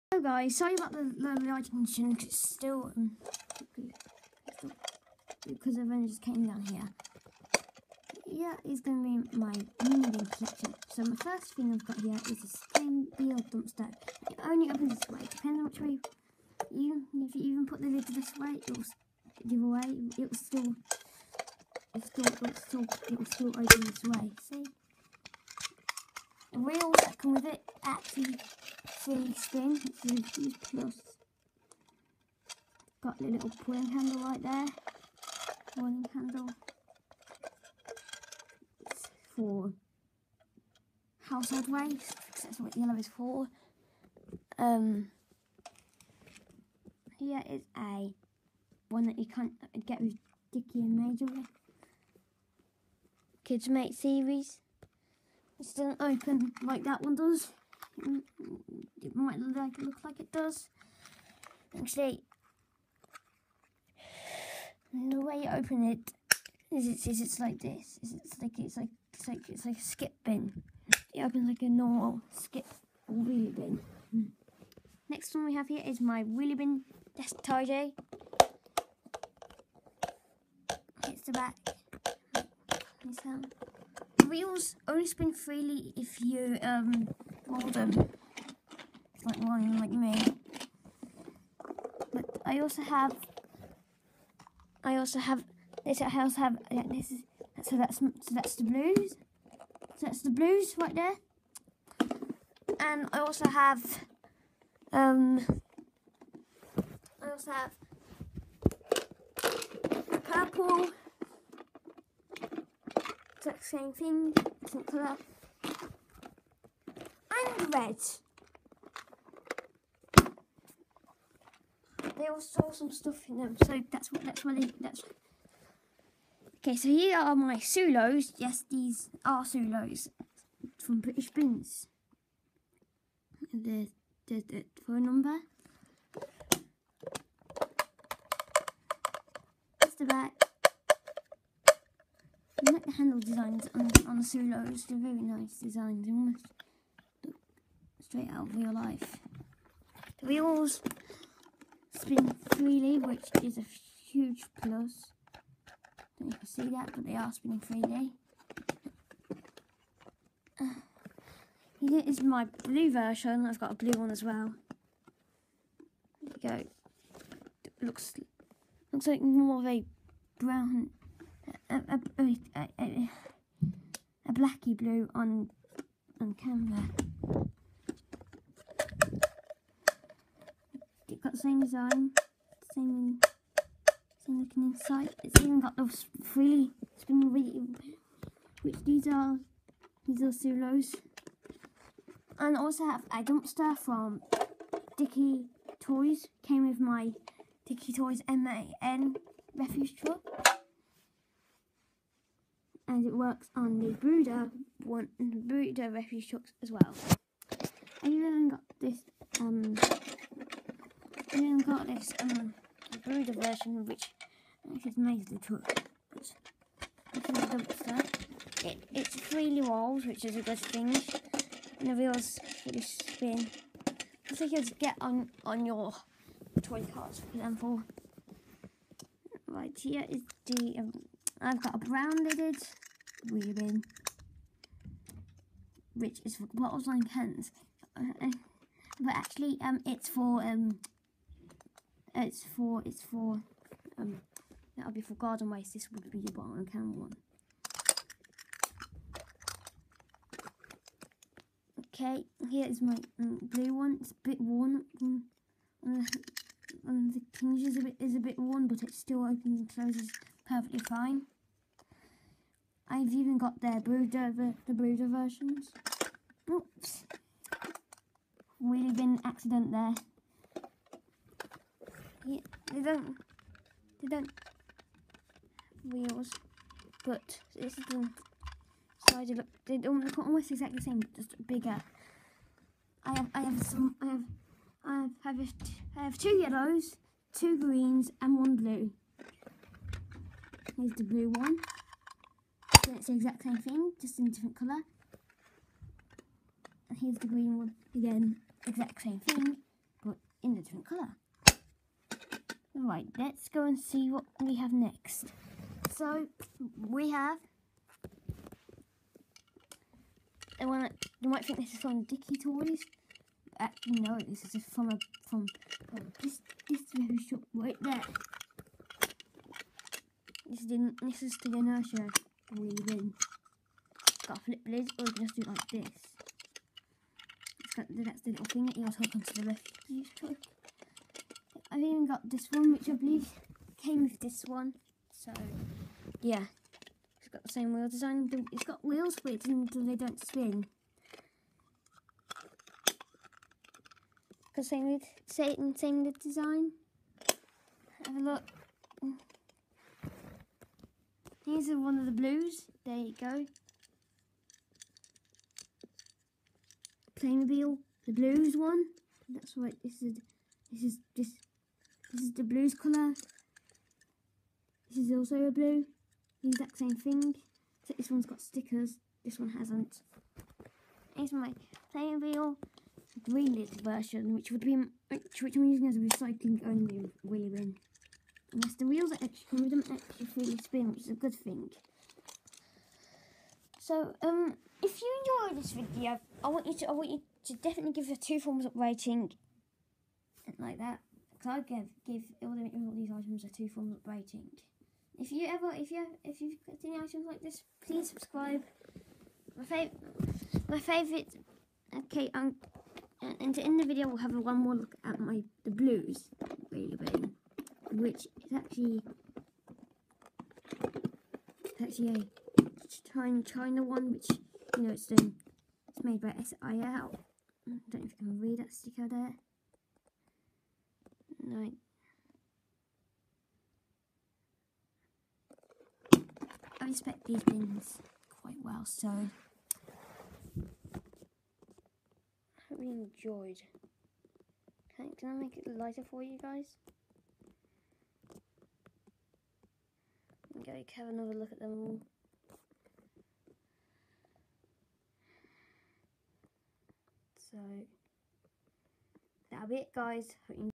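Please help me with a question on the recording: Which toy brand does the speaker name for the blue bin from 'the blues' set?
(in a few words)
Playmobil.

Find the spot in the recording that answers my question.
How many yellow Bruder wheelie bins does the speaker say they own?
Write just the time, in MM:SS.
04:46.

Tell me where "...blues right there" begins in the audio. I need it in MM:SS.
01:40.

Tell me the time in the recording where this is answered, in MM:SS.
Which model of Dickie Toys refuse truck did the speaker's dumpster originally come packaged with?
03:18.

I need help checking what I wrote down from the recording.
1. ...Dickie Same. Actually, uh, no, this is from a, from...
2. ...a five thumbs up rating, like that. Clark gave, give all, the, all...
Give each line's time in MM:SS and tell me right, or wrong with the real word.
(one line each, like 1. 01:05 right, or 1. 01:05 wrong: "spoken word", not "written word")
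1. 05:12 wrong: "Toys", not "Same"
2. 06:28 wrong: "two", not "five".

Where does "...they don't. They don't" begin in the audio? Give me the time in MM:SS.
04:32.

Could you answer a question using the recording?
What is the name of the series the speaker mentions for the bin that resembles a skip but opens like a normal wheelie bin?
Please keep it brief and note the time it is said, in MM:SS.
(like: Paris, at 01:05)
Kids Mate, at 00:53.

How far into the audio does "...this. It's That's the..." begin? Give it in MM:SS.
05:25.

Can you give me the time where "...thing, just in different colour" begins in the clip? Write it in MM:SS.
04:53.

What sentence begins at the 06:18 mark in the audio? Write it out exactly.
Yes, the wheels are extra, with them extra freely spin, which is a good thing.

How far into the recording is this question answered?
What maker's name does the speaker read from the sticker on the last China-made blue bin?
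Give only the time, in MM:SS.
06:56.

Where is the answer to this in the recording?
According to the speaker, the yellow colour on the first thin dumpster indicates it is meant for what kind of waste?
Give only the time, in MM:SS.
00:41.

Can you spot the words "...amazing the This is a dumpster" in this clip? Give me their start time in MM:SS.
03:34.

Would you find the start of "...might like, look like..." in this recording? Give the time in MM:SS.
00:59.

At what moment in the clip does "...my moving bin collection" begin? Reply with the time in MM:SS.
00:09.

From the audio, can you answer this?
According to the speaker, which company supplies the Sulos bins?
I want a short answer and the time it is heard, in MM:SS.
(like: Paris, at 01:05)
British Bins, at 02:10.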